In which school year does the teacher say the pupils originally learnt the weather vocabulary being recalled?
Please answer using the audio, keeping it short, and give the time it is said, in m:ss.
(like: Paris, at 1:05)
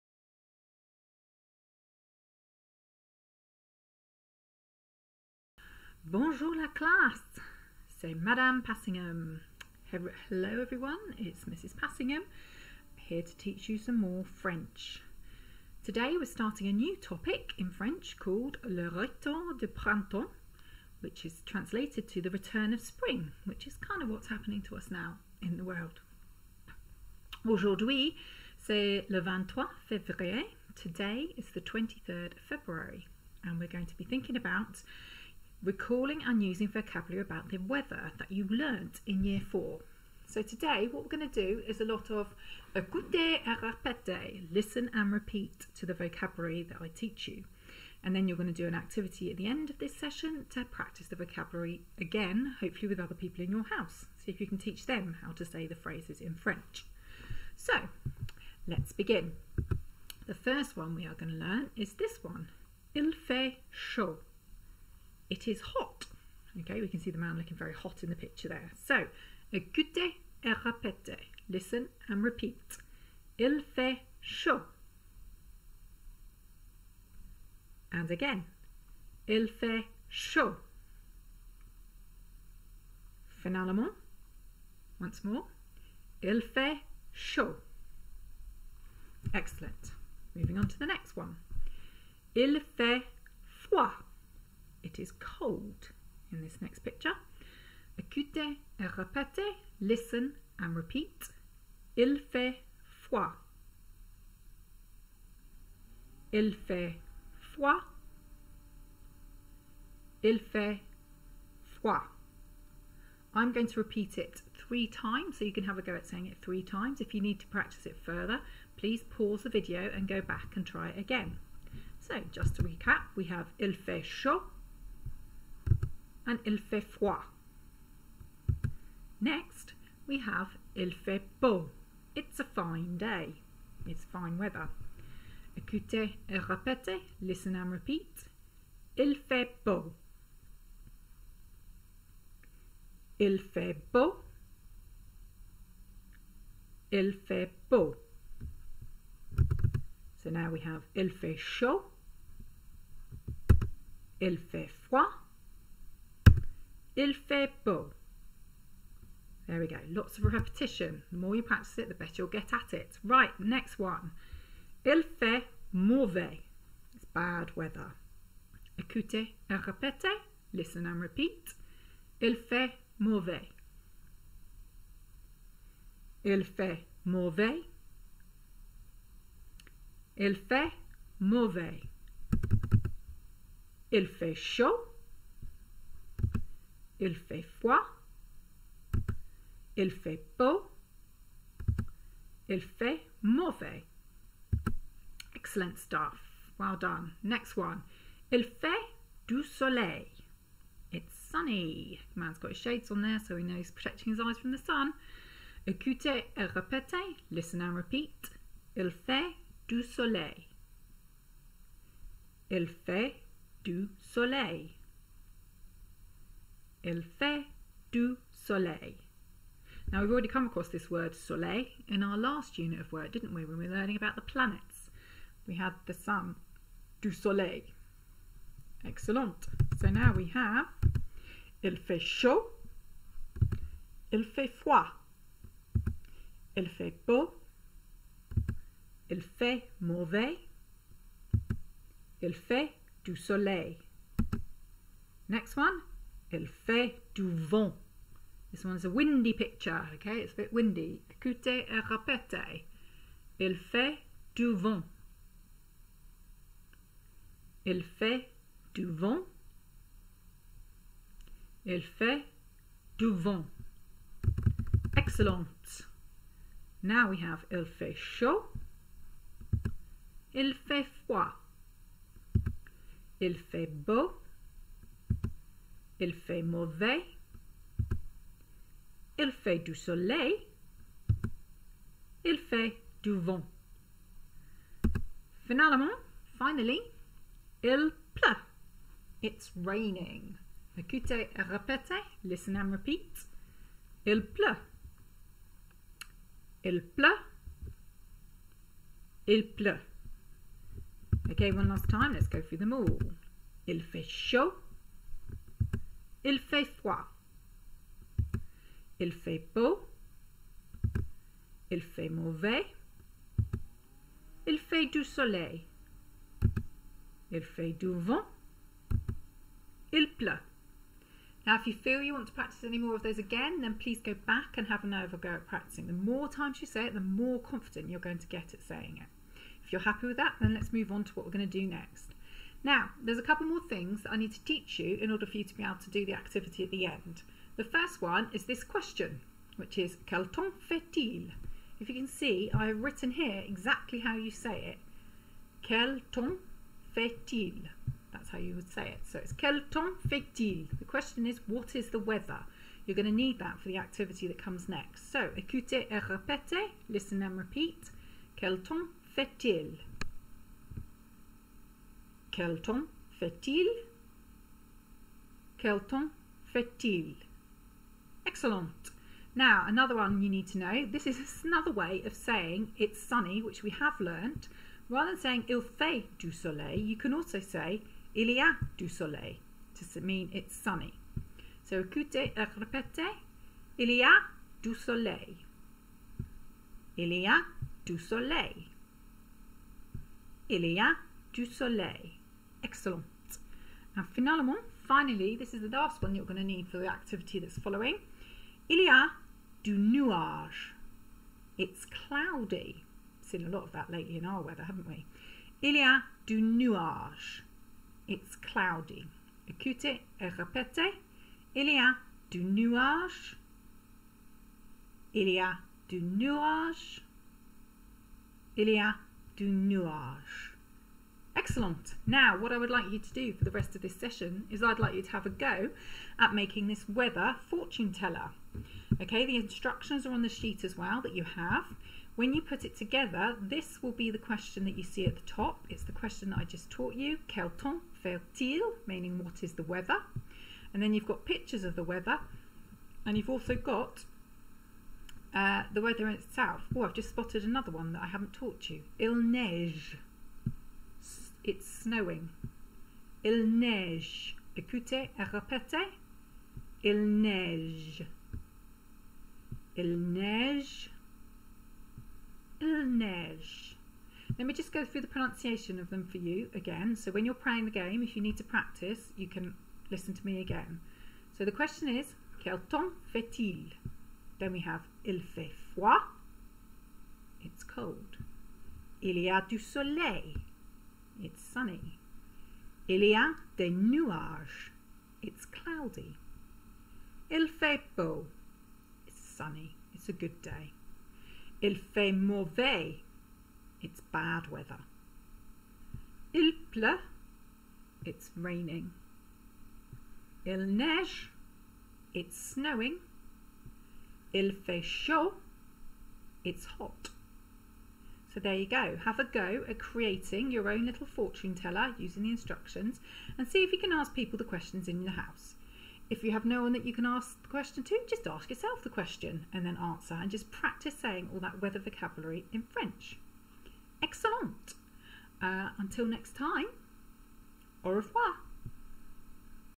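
Year 4, at 0:39.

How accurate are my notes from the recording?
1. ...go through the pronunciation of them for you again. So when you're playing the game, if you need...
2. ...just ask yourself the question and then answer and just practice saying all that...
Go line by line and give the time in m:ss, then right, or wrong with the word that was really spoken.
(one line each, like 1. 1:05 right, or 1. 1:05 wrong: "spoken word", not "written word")
1. 7:44 right
2. 8:38 right.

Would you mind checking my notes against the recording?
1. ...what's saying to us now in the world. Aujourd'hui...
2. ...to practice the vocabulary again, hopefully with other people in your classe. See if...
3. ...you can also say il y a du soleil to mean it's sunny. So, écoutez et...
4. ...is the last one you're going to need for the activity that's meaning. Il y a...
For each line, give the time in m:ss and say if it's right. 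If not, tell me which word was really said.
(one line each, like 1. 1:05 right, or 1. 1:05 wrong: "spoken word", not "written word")
1. 0:24 wrong: "happening", not "saying"
2. 0:50 wrong: "house", not "classe"
3. 6:16 right
4. 6:35 wrong: "following", not "meaning".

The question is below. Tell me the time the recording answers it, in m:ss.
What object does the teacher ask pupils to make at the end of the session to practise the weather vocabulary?
7:06.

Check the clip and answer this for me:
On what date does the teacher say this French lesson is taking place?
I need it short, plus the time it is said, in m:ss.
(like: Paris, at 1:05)
23rd of February, at 0:31.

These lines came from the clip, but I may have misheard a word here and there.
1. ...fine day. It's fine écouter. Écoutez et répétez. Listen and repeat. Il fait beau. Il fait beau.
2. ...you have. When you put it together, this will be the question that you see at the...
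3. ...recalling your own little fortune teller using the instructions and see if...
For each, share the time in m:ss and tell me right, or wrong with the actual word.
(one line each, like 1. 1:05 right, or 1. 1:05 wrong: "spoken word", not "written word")
1. 2:12 wrong: "weather", not "écouter"
2. 7:11 right
3. 8:29 wrong: "creating", not "recalling".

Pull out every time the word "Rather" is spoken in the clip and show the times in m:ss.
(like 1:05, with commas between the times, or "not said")
6:14.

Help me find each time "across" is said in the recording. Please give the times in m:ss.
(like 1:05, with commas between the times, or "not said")
3:40.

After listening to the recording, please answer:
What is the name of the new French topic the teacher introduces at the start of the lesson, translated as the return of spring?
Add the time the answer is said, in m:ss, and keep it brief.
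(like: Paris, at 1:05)
Le Retour de Printemps, at 0:18.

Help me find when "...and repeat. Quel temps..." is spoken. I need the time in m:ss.
5:57.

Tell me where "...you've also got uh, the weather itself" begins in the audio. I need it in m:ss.
7:23.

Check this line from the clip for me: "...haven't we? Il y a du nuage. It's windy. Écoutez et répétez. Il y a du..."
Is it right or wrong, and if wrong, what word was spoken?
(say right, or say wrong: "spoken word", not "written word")
wrong: "cloudy", not "windy".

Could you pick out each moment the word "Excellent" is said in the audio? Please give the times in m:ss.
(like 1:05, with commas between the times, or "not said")
1:29, 3:15, 3:48, 4:24, 6:08, 6:32, 7:01, 8:44.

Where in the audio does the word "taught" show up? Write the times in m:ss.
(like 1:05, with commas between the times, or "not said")
7:16, 7:28.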